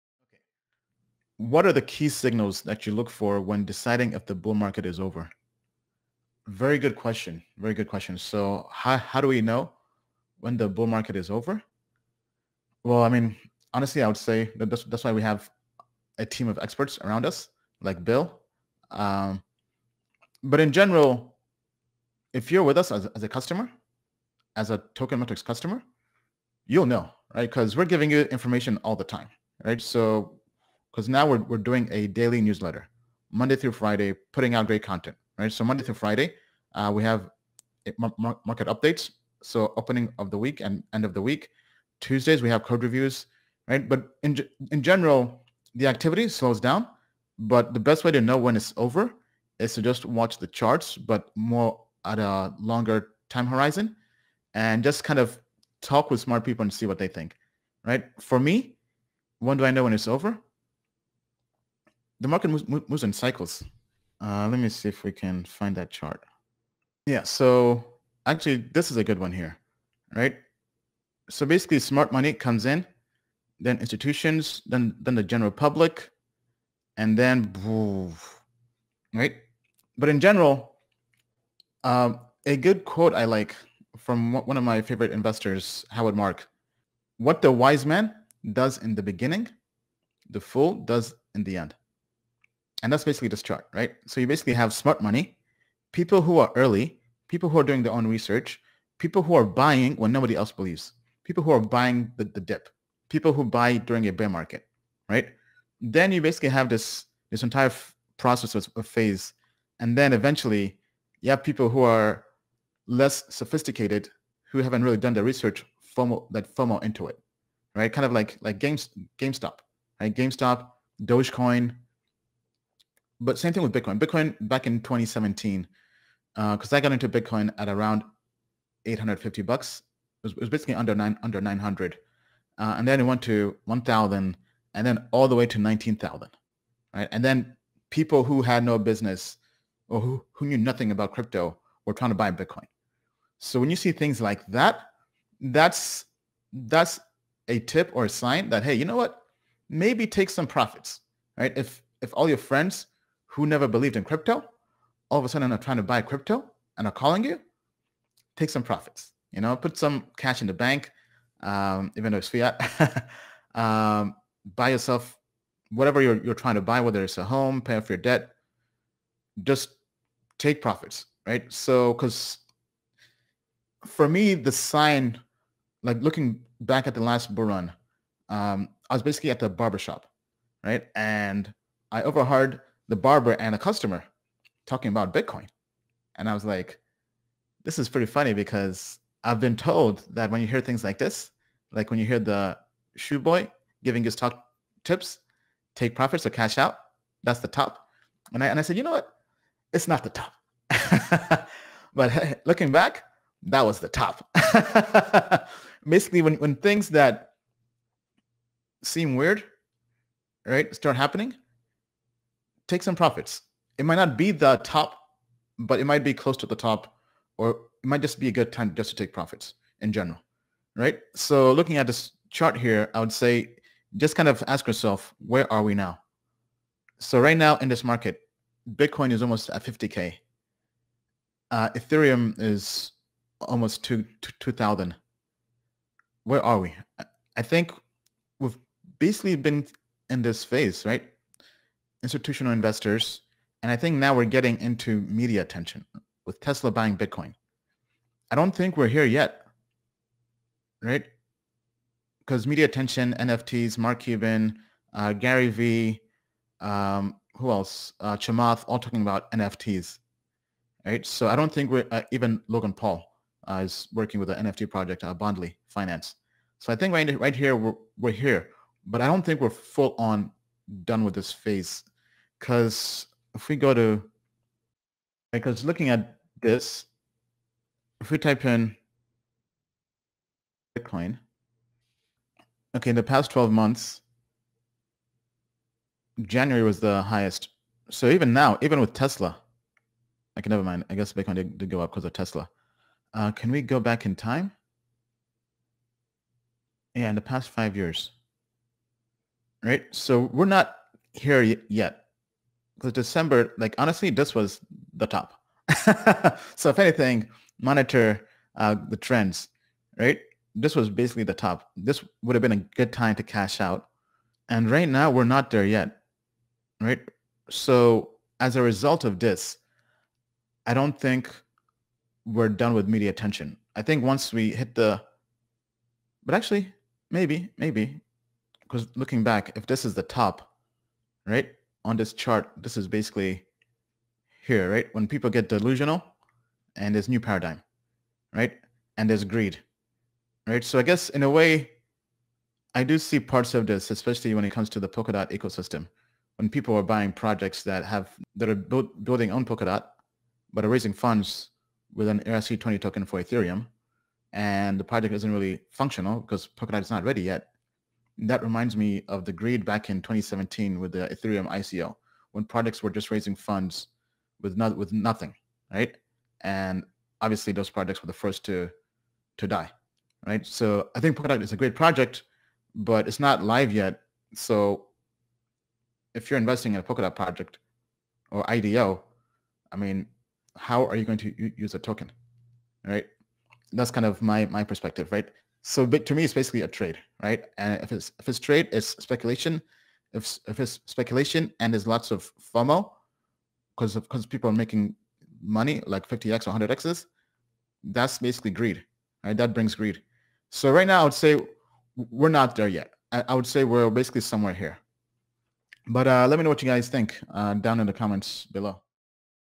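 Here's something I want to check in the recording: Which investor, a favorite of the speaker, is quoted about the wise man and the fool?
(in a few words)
Howard Mark.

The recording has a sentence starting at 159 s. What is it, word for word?
You know, put some cash in the bank, um, even though it's fiat.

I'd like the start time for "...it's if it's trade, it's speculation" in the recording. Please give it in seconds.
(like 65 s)
387 s.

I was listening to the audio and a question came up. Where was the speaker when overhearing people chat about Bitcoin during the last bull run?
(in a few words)
The barbershop.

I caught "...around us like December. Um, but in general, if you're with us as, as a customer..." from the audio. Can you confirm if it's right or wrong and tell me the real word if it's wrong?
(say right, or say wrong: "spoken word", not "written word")
wrong: "Bill", not "December".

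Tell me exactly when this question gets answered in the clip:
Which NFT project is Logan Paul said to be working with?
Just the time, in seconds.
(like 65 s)
265 s.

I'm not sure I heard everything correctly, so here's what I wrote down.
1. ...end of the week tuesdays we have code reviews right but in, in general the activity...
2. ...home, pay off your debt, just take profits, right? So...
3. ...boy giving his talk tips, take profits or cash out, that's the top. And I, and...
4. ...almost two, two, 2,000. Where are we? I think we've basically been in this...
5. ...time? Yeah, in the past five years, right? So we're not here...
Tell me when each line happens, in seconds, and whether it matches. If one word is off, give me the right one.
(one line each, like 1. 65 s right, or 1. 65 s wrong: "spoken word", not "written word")
1. 40 s right
2. 167 s right
3. 193 s right
4. 233 s right
5. 294 s right.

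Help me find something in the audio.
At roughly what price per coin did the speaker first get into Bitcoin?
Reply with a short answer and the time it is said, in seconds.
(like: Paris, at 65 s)
$850, at 128 s.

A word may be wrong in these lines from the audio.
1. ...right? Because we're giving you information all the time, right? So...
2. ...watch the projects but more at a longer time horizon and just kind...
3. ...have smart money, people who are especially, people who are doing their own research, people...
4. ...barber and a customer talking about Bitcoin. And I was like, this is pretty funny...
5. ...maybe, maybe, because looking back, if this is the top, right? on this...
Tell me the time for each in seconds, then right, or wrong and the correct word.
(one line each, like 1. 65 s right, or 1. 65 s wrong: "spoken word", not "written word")
1. 27 s right
2. 50 s wrong: "charts", not "projects"
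3. 94 s wrong: "early", not "especially"
4. 182 s right
5. 327 s right.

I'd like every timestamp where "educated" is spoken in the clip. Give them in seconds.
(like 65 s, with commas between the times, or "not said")
not said.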